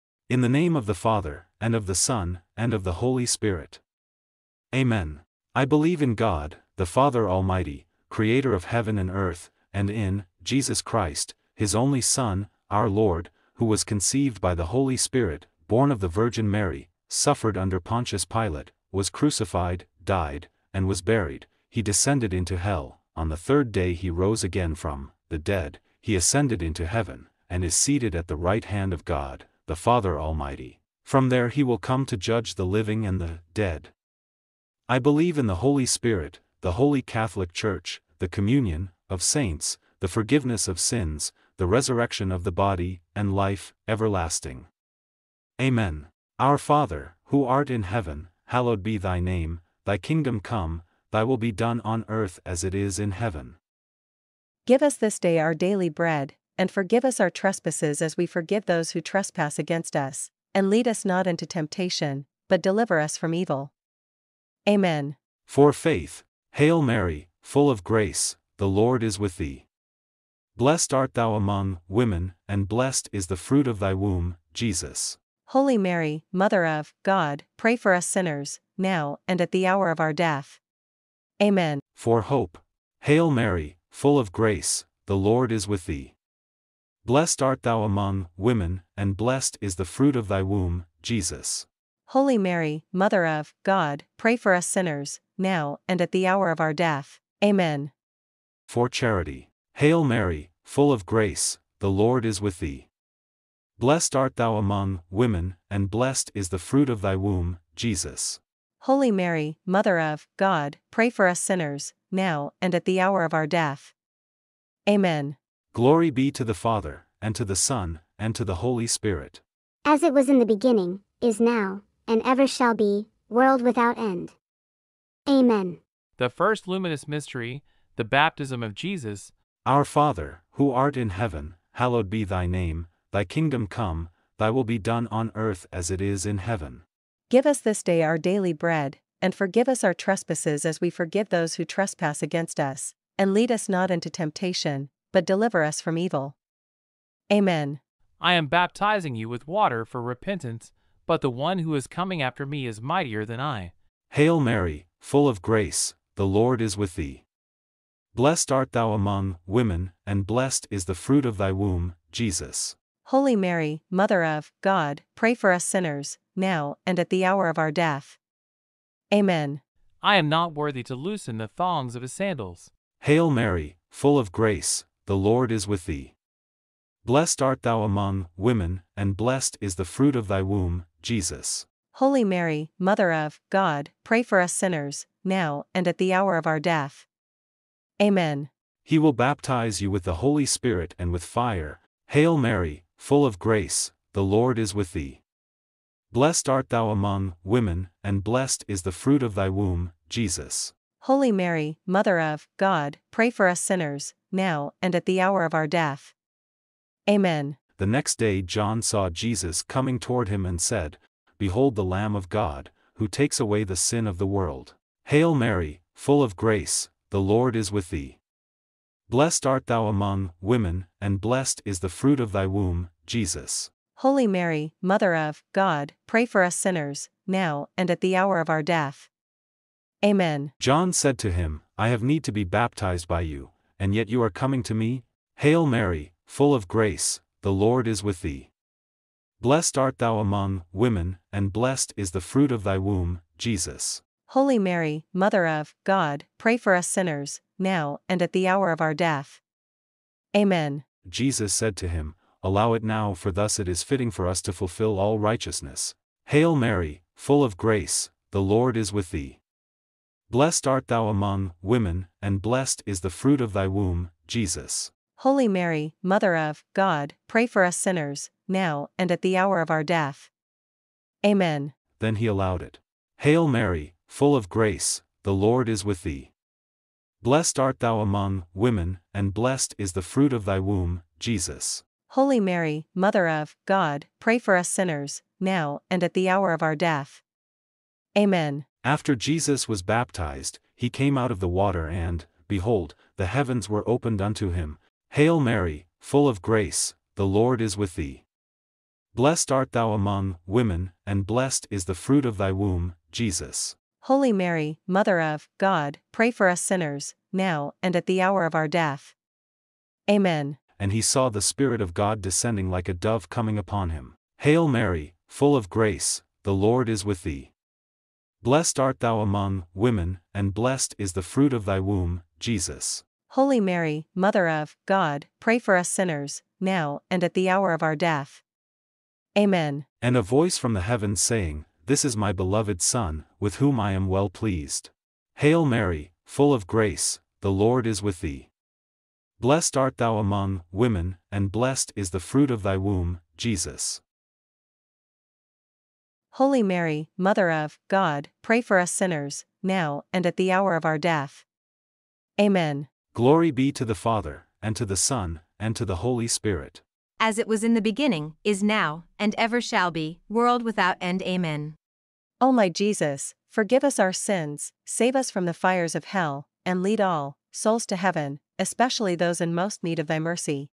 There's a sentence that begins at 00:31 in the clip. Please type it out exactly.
From there he will come to judge the living and the dead.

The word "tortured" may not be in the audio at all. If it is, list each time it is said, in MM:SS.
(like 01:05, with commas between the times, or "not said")
not said.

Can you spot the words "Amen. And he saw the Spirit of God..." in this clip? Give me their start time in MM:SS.
05:10.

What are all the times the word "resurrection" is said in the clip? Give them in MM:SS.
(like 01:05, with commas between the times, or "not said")
00:41.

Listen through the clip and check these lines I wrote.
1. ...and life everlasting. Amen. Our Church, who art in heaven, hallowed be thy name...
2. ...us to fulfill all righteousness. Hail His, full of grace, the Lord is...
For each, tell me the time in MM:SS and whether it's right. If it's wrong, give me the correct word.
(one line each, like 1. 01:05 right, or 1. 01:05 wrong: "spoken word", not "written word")
1. 00:43 wrong: "Father", not "Church"
2. 04:14 wrong: "Mary", not "His".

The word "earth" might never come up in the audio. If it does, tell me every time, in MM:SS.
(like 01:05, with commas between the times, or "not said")
00:09, 00:52, 02:15.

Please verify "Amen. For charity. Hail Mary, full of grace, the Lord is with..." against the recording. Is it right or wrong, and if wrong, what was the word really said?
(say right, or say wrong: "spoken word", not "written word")
right.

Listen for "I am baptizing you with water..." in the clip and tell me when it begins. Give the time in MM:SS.
02:28.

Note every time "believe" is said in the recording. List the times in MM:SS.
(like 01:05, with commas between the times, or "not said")
00:05, 00:34.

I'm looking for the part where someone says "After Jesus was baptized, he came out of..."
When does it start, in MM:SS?
04:48.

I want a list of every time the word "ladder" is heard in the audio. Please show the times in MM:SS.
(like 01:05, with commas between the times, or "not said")
not said.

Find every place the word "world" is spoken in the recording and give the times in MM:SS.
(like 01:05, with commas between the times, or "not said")
02:03, 03:34, 06:00.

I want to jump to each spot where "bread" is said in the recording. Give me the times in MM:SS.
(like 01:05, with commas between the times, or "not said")
00:55, 02:18.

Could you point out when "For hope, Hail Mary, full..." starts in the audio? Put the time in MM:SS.
01:21.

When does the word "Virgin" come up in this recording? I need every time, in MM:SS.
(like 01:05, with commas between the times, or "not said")
00:16.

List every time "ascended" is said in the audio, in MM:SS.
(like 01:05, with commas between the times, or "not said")
00:26.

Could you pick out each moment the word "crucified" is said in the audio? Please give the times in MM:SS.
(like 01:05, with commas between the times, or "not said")
00:19.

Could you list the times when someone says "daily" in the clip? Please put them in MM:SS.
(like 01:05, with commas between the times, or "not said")
00:55, 02:18.